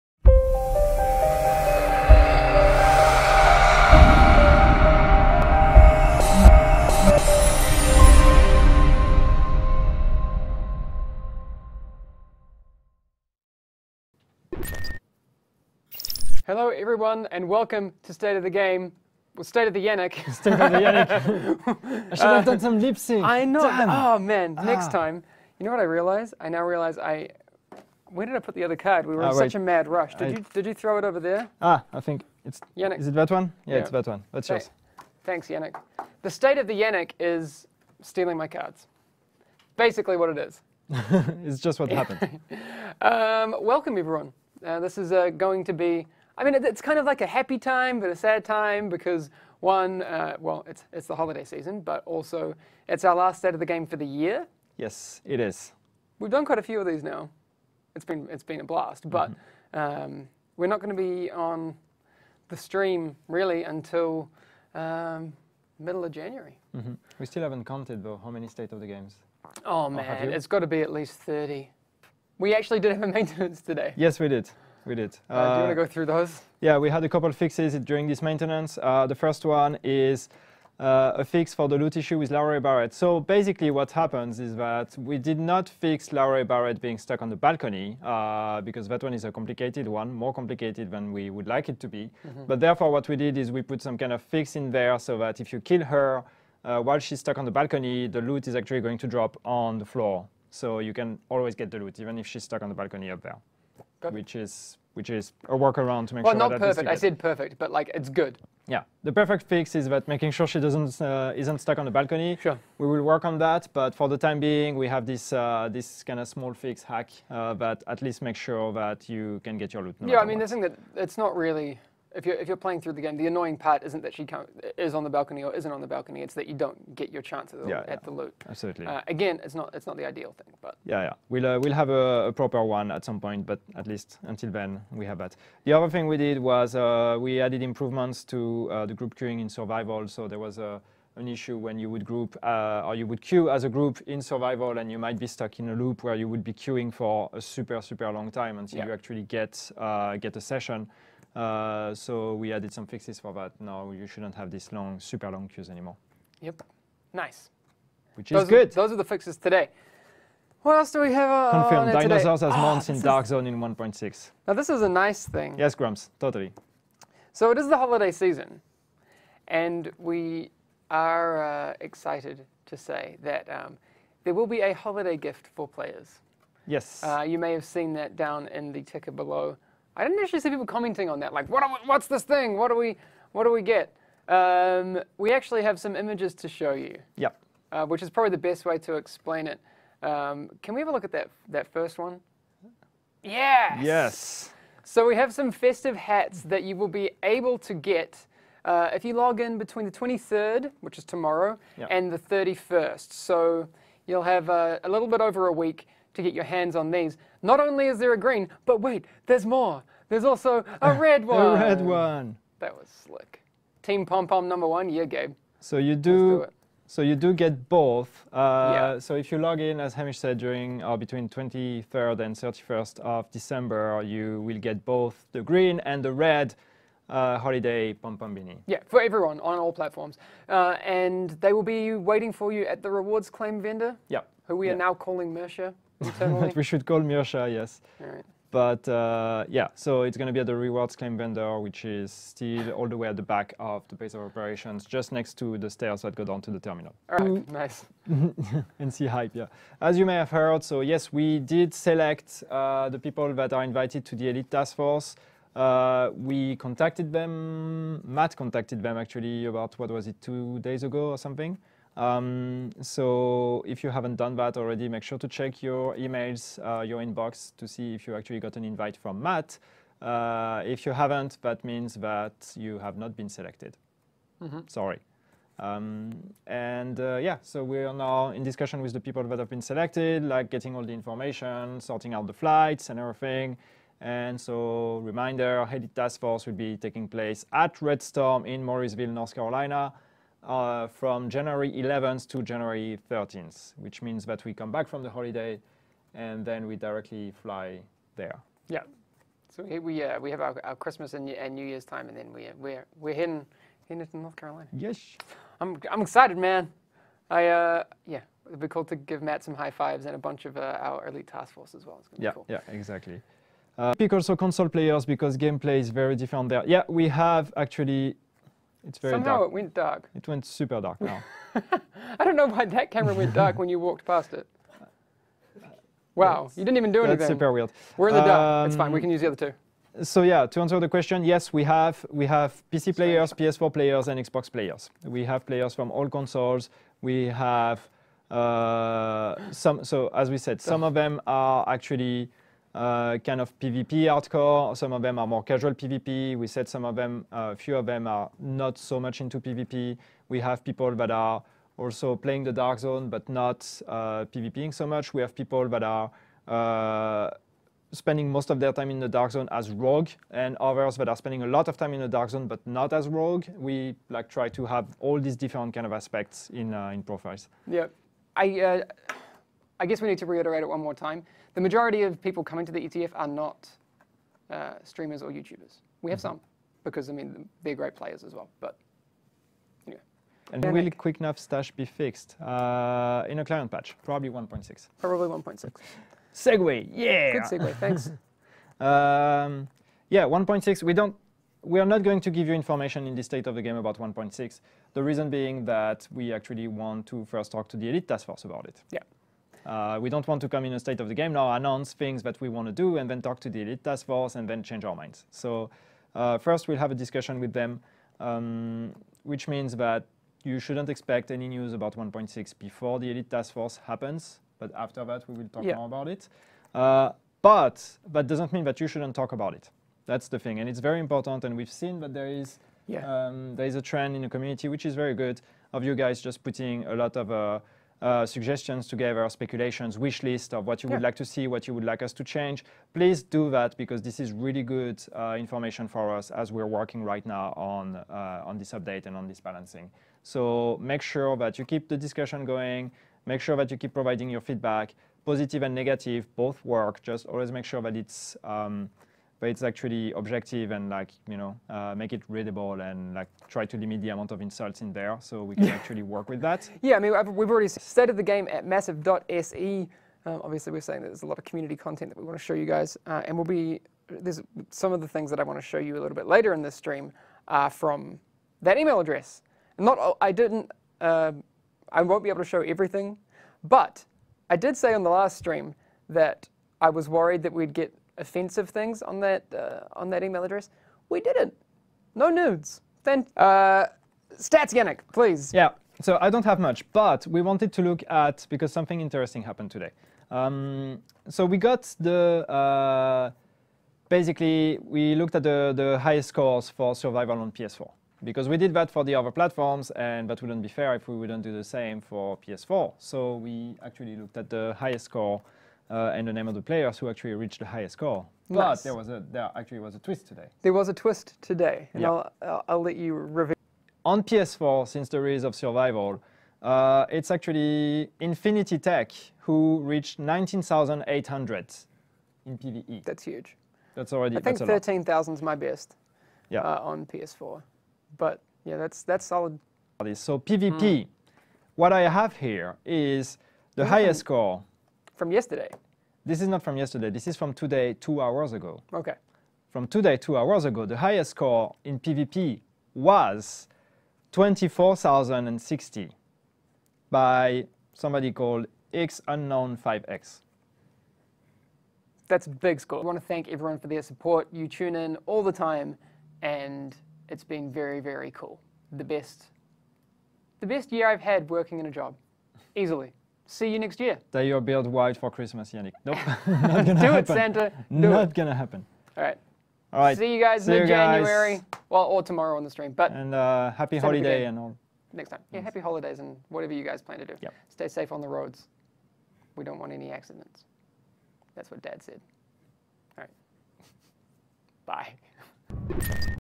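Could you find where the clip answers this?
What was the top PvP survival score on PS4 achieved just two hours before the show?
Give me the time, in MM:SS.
09:04.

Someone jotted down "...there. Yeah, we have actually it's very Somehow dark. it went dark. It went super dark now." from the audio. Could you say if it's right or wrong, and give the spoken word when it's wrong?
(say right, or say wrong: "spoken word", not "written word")
right.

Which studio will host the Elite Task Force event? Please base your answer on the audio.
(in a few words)
Red Storm.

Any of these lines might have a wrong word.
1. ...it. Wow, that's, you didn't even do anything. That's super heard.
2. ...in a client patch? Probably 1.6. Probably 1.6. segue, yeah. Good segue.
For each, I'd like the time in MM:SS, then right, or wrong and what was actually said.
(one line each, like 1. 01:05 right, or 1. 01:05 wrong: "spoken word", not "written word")
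1. 05:24 wrong: "weird", not "heard"
2. 06:23 right.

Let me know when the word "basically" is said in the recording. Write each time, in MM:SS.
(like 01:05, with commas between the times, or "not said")
00:39, 01:23, 08:14.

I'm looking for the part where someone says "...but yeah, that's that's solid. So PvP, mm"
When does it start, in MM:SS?
08:48.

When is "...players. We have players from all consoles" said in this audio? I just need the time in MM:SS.
05:34.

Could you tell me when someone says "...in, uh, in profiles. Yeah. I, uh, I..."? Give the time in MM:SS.
06:06.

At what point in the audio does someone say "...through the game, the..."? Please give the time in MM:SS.
02:02.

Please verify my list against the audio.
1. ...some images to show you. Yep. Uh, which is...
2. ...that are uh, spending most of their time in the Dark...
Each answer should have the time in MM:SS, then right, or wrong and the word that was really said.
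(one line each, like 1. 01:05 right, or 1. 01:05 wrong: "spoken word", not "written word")
1. 03:05 right
2. 05:55 right.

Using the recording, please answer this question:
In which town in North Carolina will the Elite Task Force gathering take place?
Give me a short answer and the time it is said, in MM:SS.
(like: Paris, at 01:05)
Morrisville, at 04:48.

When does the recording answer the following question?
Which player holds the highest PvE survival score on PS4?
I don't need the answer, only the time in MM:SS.
08:38.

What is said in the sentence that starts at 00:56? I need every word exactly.
We've done quite a few of these now.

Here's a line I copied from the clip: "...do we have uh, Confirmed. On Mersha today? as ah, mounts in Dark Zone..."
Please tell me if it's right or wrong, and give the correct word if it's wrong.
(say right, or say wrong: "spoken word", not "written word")
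wrong: "Dinosaurs", not "Mersha".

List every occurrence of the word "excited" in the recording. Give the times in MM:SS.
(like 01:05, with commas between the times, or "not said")
02:51, 05:06.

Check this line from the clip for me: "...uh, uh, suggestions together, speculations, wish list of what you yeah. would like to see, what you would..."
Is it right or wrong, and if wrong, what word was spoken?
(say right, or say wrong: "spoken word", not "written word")
right.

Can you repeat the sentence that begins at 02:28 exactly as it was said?
you actually get uh, get a session uh, so we added some fixes for that.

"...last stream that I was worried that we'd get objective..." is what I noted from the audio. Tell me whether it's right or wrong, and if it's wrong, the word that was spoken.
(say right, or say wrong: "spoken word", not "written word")
wrong: "offensive", not "objective".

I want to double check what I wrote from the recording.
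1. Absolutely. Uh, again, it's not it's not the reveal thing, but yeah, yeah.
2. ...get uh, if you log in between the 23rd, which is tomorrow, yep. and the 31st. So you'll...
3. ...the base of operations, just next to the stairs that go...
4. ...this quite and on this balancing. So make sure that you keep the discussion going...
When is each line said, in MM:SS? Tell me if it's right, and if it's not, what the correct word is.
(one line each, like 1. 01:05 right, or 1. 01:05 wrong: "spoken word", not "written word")
1. 02:08 wrong: "ideal", not "reveal"
2. 03:17 right
3. 04:03 right
4. 07:18 wrong: "update", not "quite".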